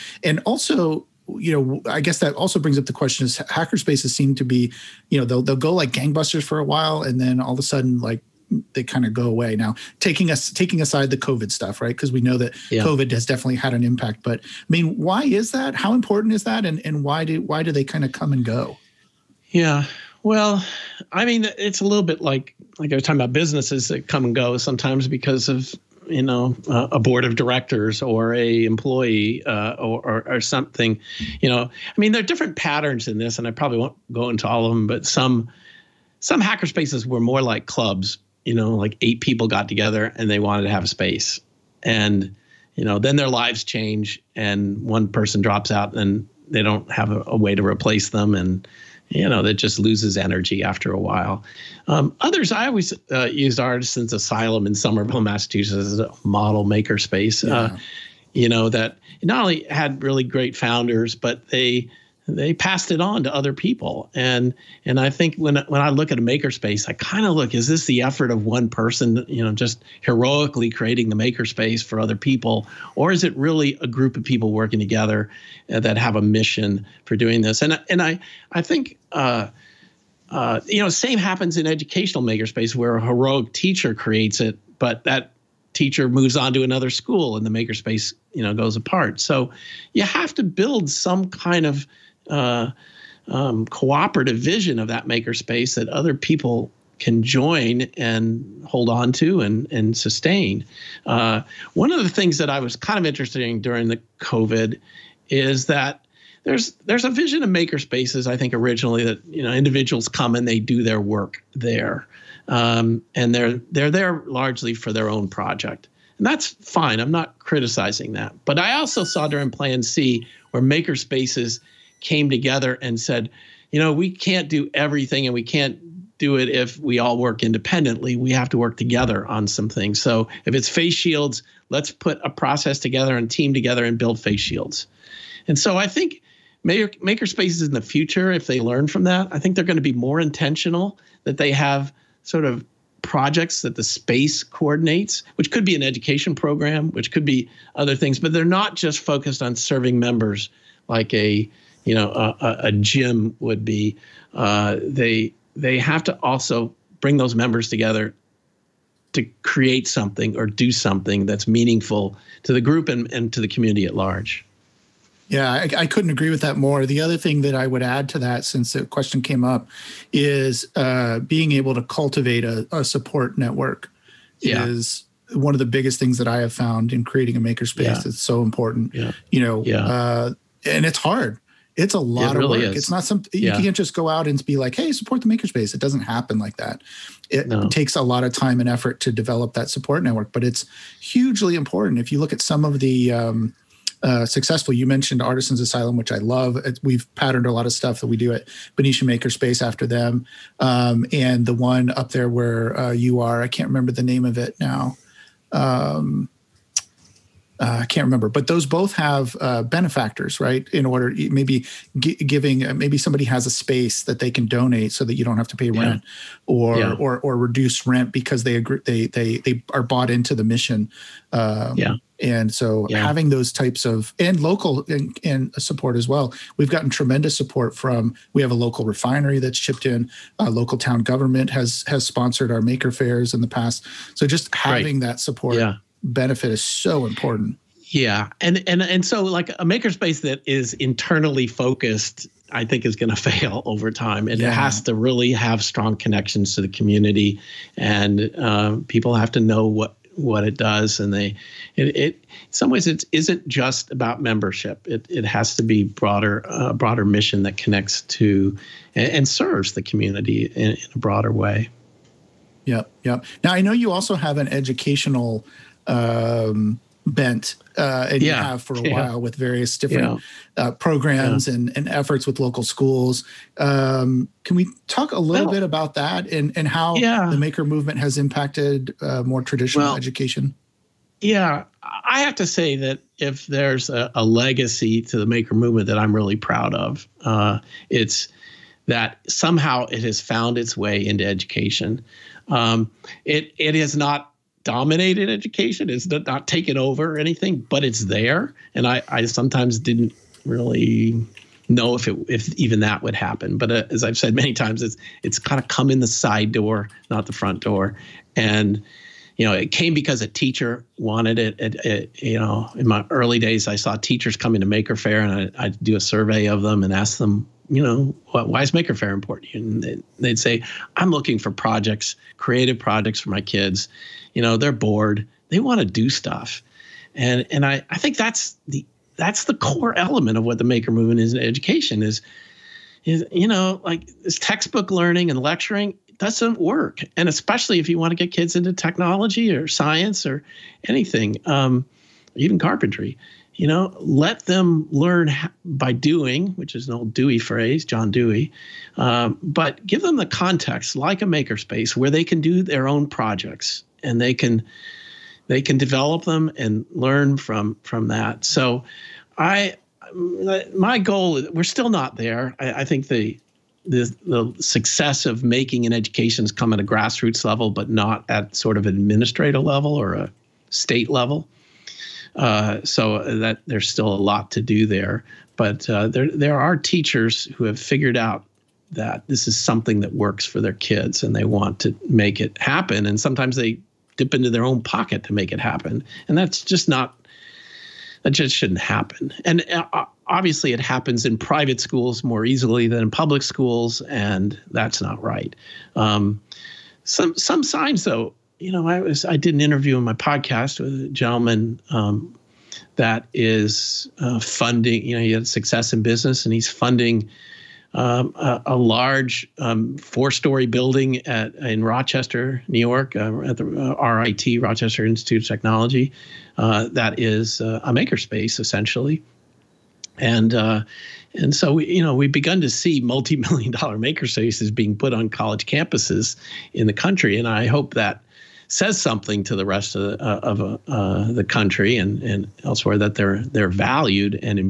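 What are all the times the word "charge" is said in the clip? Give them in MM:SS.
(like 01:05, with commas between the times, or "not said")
not said.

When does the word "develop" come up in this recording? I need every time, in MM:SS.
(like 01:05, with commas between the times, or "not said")
03:09, 05:55.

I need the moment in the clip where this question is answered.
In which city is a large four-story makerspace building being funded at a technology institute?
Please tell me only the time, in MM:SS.
06:51.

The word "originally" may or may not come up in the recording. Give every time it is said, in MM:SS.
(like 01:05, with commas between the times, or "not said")
01:48.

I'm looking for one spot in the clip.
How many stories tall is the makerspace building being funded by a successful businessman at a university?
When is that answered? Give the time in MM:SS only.
06:49.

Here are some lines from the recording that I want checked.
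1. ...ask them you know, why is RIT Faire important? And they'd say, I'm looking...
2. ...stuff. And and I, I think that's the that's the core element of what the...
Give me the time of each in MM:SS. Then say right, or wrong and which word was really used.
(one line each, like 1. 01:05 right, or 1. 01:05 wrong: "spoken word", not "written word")
1. 05:16 wrong: "Maker", not "RIT"
2. 05:26 right.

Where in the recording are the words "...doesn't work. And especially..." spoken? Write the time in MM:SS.
05:36.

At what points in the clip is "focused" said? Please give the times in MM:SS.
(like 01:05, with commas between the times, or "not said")
02:29, 04:01.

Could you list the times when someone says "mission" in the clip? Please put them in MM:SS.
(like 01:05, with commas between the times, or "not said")
01:16, 03:40, 04:17.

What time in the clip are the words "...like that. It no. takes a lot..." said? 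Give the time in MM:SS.
03:06.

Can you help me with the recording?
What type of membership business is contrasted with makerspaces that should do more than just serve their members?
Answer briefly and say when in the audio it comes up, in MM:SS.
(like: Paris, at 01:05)
A gym, at 02:32.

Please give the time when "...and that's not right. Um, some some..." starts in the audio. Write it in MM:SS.
06:34.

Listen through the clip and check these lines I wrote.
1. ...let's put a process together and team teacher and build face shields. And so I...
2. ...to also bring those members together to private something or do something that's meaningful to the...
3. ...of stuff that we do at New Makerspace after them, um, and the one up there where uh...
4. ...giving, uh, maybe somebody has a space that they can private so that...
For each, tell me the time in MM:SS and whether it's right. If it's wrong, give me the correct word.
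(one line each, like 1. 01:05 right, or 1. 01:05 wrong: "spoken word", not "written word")
1. 02:11 wrong: "together", not "teacher"
2. 02:36 wrong: "create", not "private"
3. 03:17 wrong: "Benicia", not "New"
4. 03:31 wrong: "donate", not "private".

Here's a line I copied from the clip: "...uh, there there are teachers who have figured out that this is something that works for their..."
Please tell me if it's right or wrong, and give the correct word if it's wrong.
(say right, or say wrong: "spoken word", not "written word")
right.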